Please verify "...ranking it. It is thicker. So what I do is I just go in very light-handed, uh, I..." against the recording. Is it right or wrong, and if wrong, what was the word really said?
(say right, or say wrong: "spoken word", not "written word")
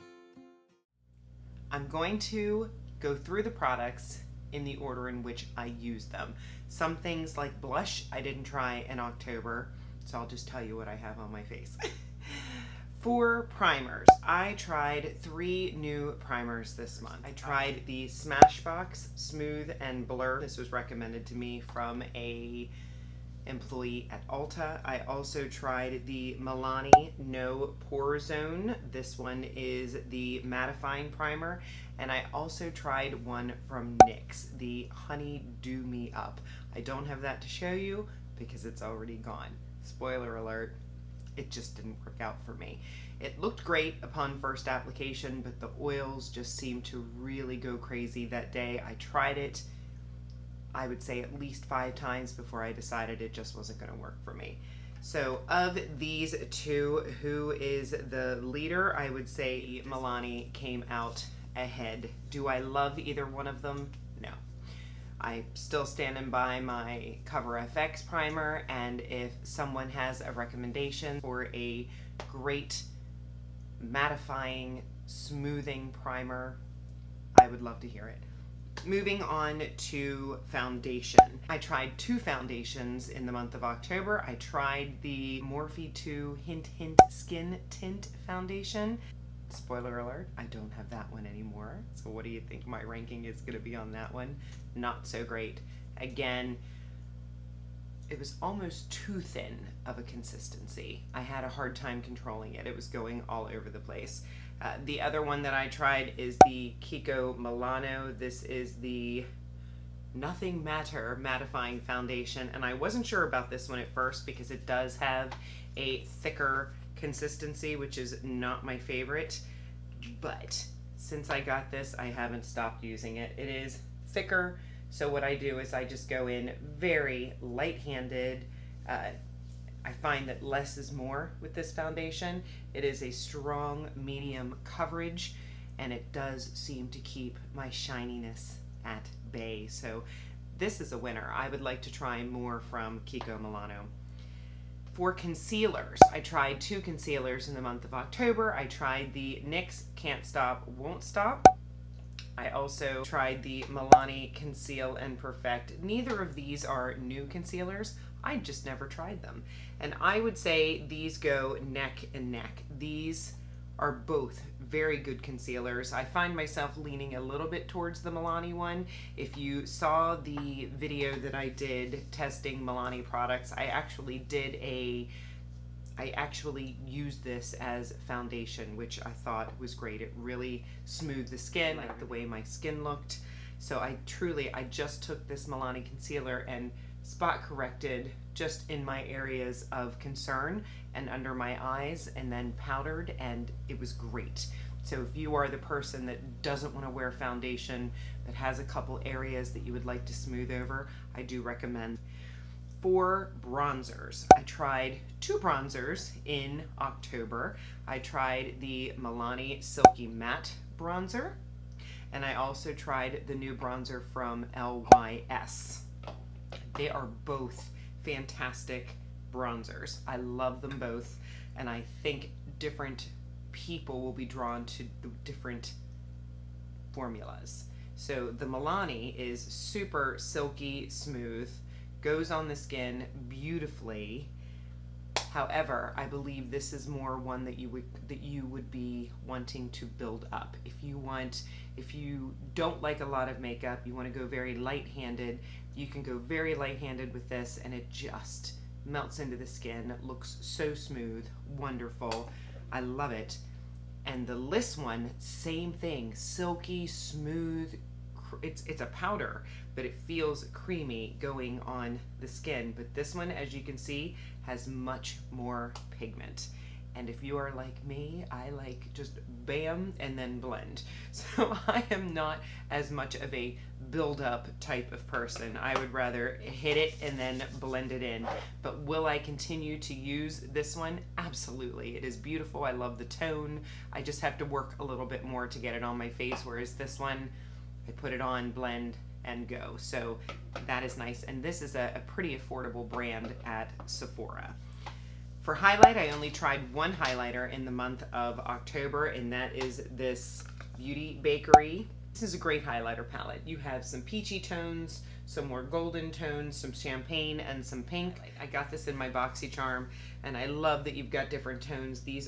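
wrong: "using", not "ranking".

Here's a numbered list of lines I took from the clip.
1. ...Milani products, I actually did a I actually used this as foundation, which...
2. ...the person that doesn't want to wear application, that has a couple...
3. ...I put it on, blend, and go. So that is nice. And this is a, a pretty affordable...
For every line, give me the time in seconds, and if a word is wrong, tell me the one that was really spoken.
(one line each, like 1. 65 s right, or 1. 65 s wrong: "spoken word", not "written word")
1. 172 s right
2. 195 s wrong: "foundation", not "application"
3. 287 s right.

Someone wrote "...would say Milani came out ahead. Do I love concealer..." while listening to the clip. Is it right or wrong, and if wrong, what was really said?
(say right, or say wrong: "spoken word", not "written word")
wrong: "either", not "concealer".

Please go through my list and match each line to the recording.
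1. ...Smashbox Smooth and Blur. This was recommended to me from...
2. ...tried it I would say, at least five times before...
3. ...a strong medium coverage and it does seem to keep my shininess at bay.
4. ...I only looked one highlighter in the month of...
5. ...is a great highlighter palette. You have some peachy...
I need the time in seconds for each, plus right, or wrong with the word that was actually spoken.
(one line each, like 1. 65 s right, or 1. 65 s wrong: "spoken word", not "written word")
1. 18 s right
2. 48 s right
3. 133 s right
4. 295 s wrong: "tried", not "looked"
5. 302 s right.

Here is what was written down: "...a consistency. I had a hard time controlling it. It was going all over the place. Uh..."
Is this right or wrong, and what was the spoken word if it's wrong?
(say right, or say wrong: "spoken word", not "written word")
right.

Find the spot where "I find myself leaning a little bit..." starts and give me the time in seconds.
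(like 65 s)
165 s.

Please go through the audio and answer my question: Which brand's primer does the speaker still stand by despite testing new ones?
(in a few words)
Cover FX.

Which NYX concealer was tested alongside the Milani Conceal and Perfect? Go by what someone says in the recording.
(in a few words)
Can't Stop, Won't Stop.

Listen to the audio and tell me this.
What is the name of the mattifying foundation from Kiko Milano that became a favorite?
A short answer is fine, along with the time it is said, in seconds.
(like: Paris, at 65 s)
Nothing Matte-R, at 110 s.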